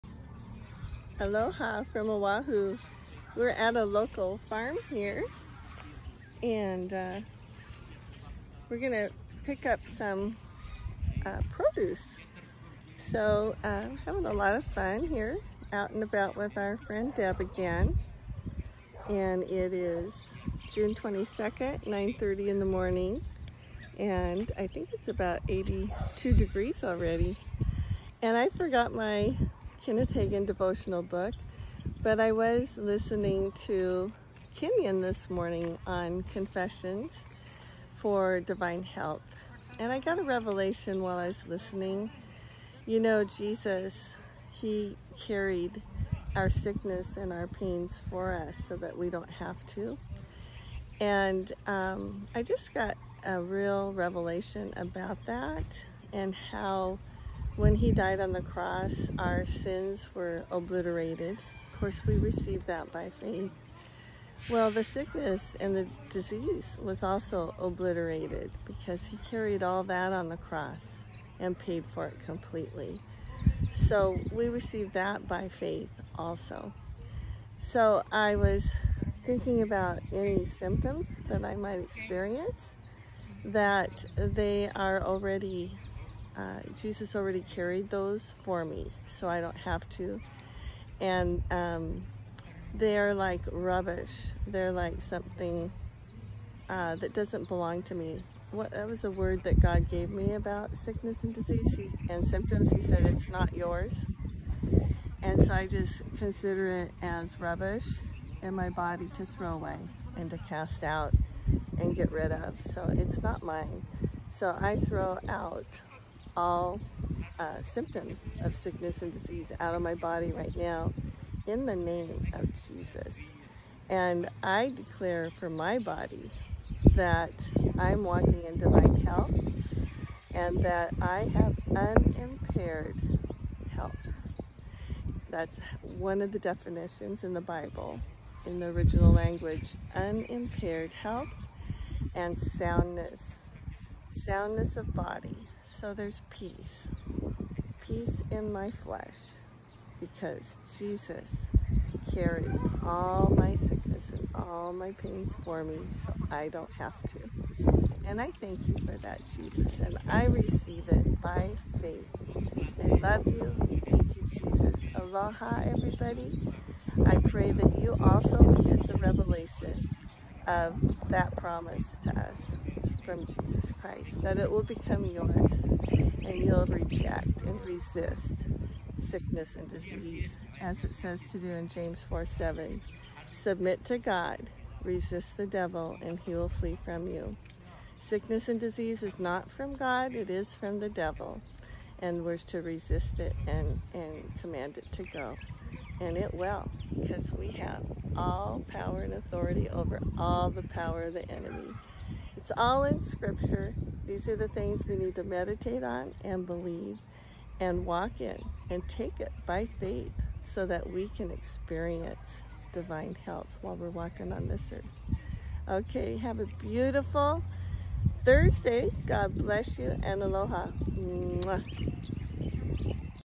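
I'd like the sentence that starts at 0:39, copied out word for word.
And I got a revelation while I was listening.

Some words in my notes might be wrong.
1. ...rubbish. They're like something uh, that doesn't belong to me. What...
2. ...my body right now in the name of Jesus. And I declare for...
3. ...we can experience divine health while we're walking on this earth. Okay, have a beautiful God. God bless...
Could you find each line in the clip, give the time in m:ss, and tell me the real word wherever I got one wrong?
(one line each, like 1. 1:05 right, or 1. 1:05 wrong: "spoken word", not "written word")
1. 1:33 right
2. 1:59 right
3. 3:30 wrong: "Thursday", not "God".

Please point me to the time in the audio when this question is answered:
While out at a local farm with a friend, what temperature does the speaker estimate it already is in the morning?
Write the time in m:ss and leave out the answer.
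0:25.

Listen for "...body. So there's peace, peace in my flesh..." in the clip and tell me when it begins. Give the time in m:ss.
2:24.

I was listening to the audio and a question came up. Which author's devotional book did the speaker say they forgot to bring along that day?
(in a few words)
Kenneth Hagin.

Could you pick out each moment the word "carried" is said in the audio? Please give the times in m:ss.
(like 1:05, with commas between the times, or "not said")
0:45, 1:09, 1:27, 2:32.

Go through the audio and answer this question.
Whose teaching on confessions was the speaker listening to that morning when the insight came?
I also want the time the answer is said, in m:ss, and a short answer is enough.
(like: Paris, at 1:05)
Kenyon, at 0:34.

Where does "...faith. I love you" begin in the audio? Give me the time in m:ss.
2:41.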